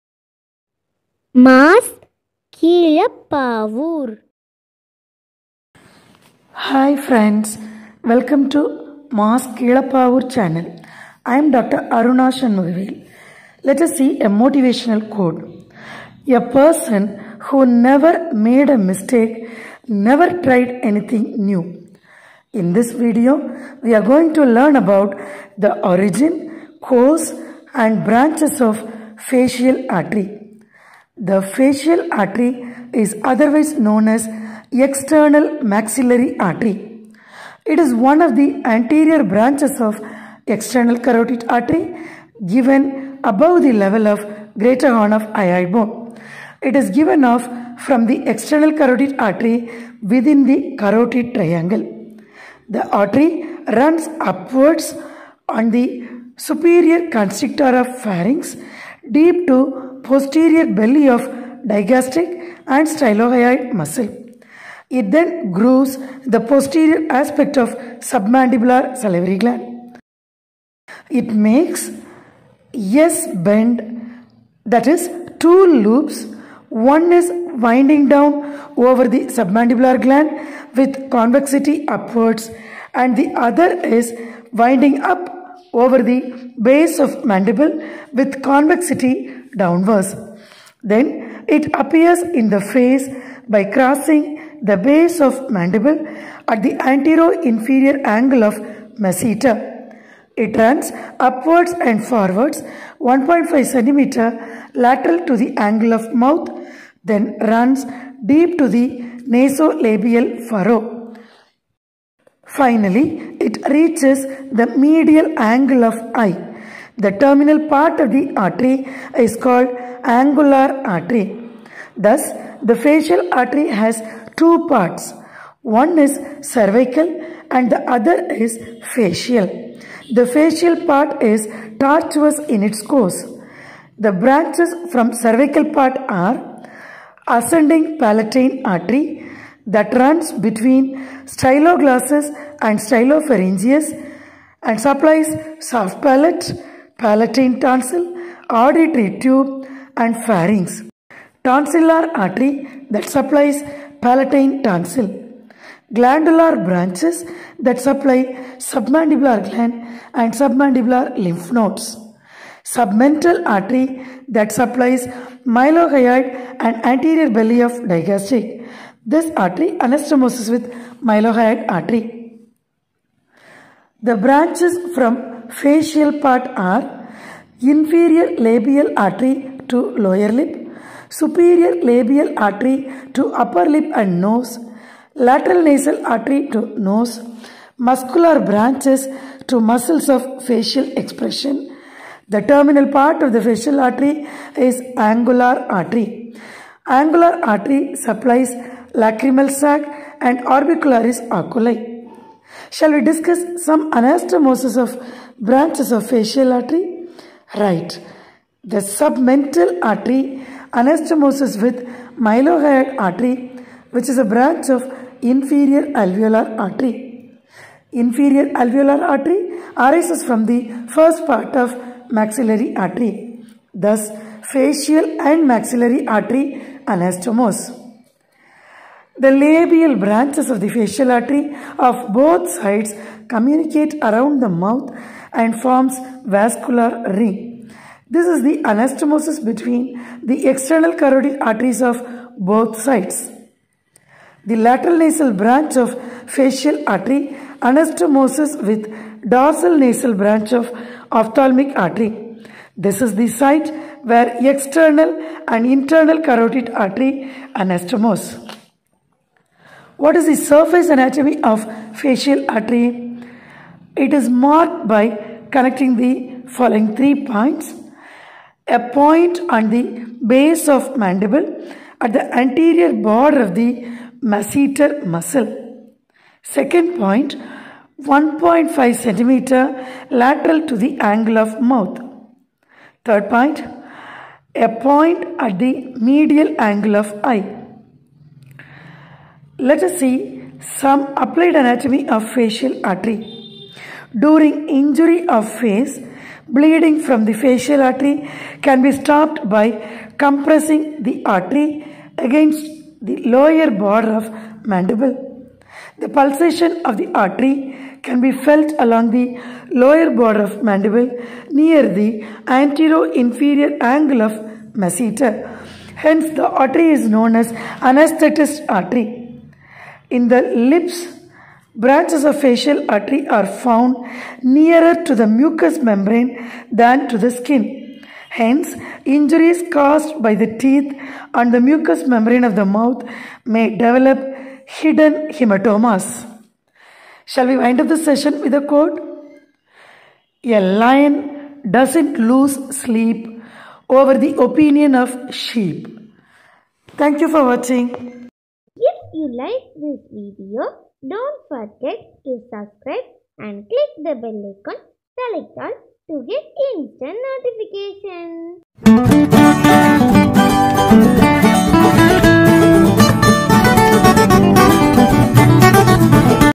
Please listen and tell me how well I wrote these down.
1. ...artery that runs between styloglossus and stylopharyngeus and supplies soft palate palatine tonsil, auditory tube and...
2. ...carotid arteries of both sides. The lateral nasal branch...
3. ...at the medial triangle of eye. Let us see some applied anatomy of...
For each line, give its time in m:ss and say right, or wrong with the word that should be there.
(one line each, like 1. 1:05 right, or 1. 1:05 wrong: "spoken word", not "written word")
1. 2:18 right
2. 4:00 right
3. 4:45 wrong: "angle", not "triangle".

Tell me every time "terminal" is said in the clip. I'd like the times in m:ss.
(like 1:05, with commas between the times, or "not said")
1:57, 3:12.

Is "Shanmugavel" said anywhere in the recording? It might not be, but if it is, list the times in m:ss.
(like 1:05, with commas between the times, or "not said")
0:12.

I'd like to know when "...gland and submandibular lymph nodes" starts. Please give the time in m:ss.
2:39.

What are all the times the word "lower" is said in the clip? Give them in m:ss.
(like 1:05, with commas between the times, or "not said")
3:00, 5:03, 5:09.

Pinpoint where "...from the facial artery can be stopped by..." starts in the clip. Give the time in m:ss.
4:57.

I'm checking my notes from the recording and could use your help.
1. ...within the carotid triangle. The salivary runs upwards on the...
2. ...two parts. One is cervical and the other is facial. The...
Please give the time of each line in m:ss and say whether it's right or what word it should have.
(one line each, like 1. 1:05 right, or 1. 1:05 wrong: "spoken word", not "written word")
1. 0:50 wrong: "artery", not "salivary"
2. 2:04 right.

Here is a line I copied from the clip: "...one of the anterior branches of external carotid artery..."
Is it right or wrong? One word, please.
right.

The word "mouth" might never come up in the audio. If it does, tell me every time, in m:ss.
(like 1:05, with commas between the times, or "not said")
1:46, 3:54, 4:41, 5:32.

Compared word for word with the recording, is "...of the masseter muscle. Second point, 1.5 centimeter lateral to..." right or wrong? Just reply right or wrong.
right.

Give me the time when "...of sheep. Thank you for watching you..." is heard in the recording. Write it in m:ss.
5:44.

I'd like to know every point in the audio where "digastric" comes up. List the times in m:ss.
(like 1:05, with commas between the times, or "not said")
1:01, 2:47.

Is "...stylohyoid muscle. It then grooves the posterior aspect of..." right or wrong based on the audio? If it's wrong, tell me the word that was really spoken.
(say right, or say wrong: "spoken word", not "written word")
right.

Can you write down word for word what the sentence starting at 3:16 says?
Angular artery supplies lacrimal sac and orbicularis oculi.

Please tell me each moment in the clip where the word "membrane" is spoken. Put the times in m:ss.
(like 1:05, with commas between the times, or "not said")
5:25, 5:32.